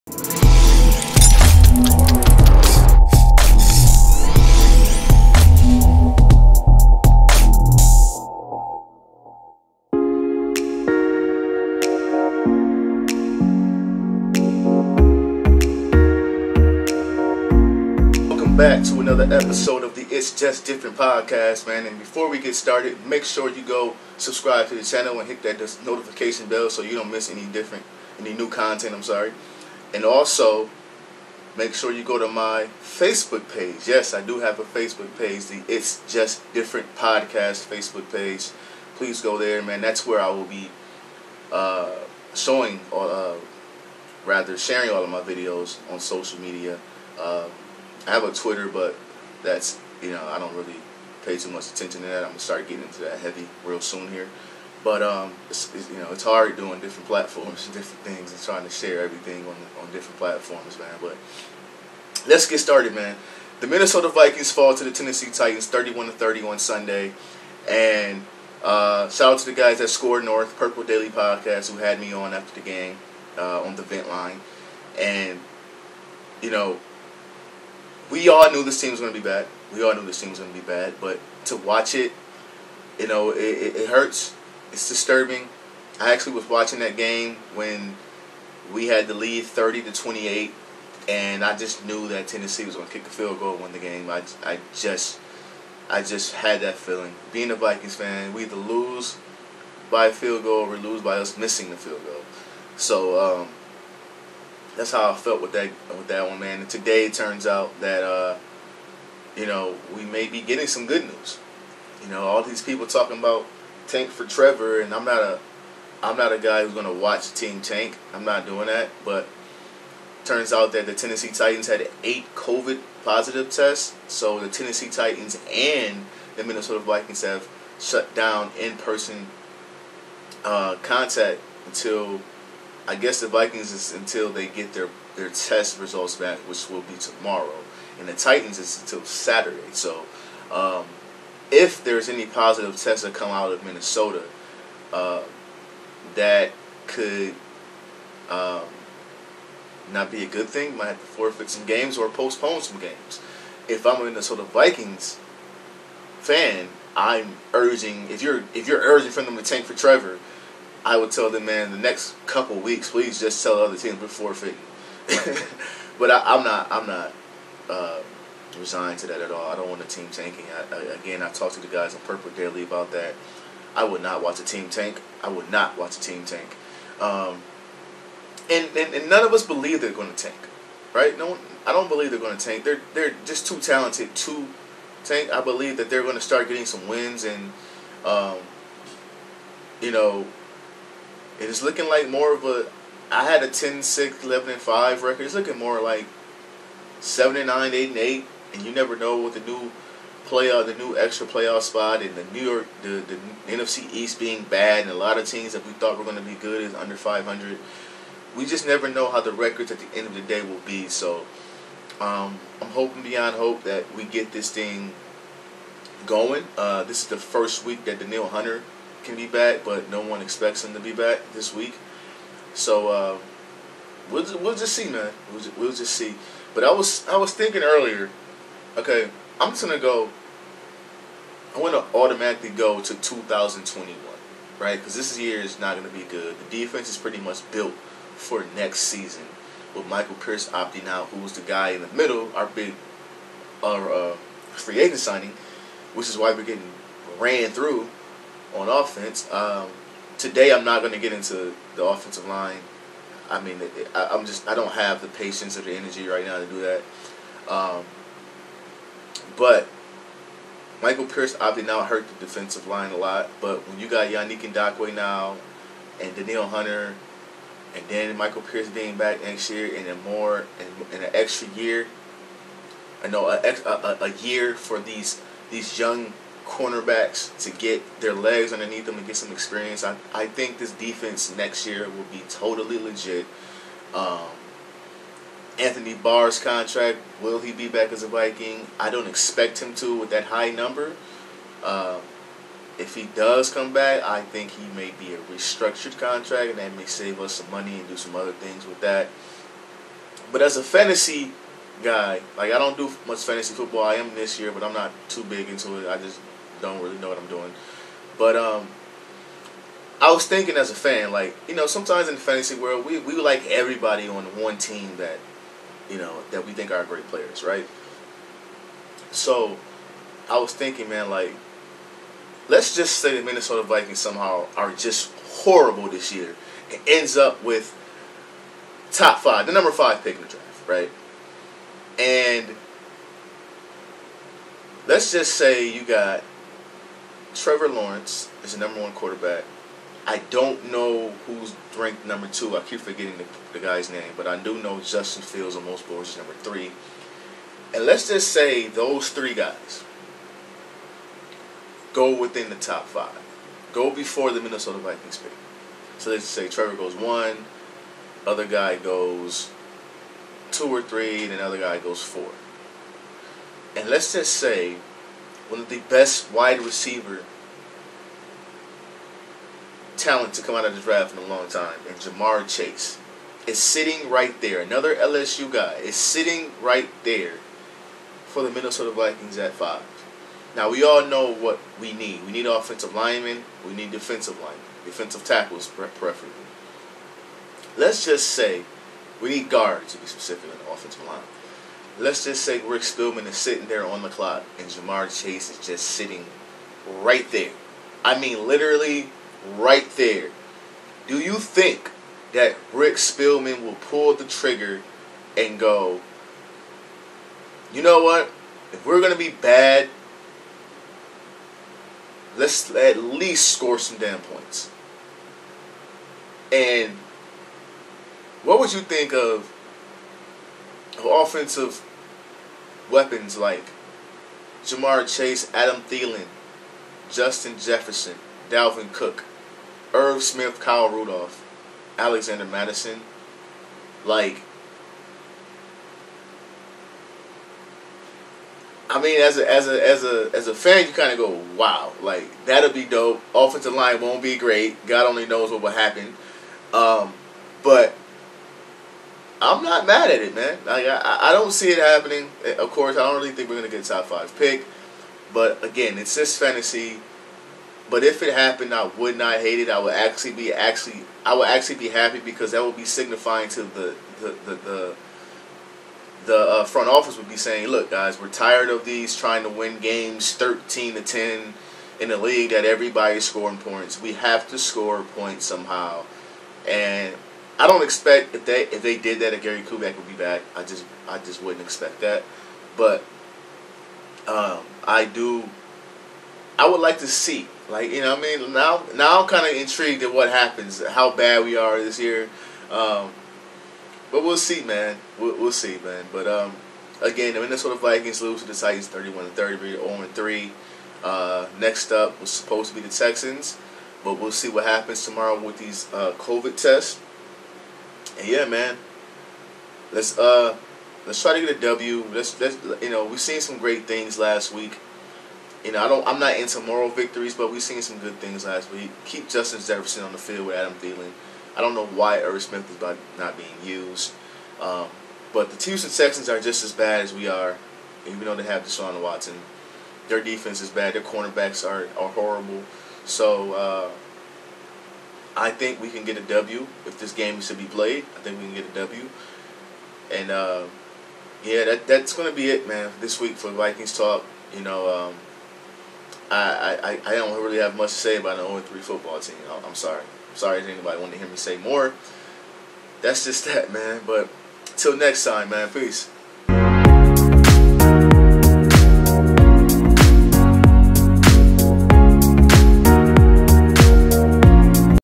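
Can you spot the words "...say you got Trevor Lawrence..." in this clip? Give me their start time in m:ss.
5:35.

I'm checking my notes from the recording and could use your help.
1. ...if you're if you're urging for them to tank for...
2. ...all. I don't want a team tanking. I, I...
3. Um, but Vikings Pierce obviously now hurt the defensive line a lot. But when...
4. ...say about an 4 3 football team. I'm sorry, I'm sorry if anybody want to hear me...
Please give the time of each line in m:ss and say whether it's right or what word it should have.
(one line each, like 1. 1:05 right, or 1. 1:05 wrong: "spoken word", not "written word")
1. 2:38 right
2. 2:49 right
3. 4:17 wrong: "Michael", not "Vikings"
4. 9:07 wrong: "0", not "4".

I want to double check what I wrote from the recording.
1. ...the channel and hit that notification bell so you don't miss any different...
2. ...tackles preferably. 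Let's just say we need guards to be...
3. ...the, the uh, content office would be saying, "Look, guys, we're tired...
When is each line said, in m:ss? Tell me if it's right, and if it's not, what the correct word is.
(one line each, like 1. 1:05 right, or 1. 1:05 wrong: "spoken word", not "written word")
1. 0:24 right
2. 6:25 right
3. 7:44 wrong: "front", not "content".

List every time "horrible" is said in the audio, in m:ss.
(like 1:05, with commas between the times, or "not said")
5:25, 8:52.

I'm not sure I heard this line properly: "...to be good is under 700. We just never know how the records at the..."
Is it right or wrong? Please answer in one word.
wrong.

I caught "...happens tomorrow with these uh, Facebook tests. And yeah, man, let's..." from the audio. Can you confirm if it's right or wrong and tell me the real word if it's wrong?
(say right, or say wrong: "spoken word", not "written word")
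wrong: "COVID", not "Facebook".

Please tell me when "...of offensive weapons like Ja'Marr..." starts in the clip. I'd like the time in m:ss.
7:01.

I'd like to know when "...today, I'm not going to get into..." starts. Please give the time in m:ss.
4:10.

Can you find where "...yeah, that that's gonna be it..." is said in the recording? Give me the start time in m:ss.
9:01.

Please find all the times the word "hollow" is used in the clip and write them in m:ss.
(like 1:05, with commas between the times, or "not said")
not said.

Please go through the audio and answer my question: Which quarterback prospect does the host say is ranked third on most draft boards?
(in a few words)
Justin Fields.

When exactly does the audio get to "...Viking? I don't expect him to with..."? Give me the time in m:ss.
4:48.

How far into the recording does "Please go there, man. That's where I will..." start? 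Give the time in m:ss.
0:38.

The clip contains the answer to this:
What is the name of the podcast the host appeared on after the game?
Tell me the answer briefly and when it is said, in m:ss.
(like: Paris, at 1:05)
Purple Daily Podcast, at 1:10.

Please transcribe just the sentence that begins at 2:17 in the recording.
And the Titans is until Saturday.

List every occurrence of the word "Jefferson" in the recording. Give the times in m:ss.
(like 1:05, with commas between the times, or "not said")
7:07, 8:39.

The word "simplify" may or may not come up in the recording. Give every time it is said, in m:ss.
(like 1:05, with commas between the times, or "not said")
not said.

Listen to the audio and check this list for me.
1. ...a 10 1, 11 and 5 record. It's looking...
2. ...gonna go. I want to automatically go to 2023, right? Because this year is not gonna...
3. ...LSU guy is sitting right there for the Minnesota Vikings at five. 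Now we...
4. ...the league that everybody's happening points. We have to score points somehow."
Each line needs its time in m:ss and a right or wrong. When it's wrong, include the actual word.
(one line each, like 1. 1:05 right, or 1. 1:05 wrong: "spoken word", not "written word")
1. 3:13 wrong: "6", not "1"
2. 3:49 wrong: "2021", not "2023"
3. 6:14 right
4. 7:52 wrong: "scoring", not "happening".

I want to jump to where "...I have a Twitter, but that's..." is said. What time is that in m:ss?
0:48.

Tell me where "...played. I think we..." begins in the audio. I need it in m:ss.
8:57.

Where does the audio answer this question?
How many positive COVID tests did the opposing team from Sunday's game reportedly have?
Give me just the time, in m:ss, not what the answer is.
2:02.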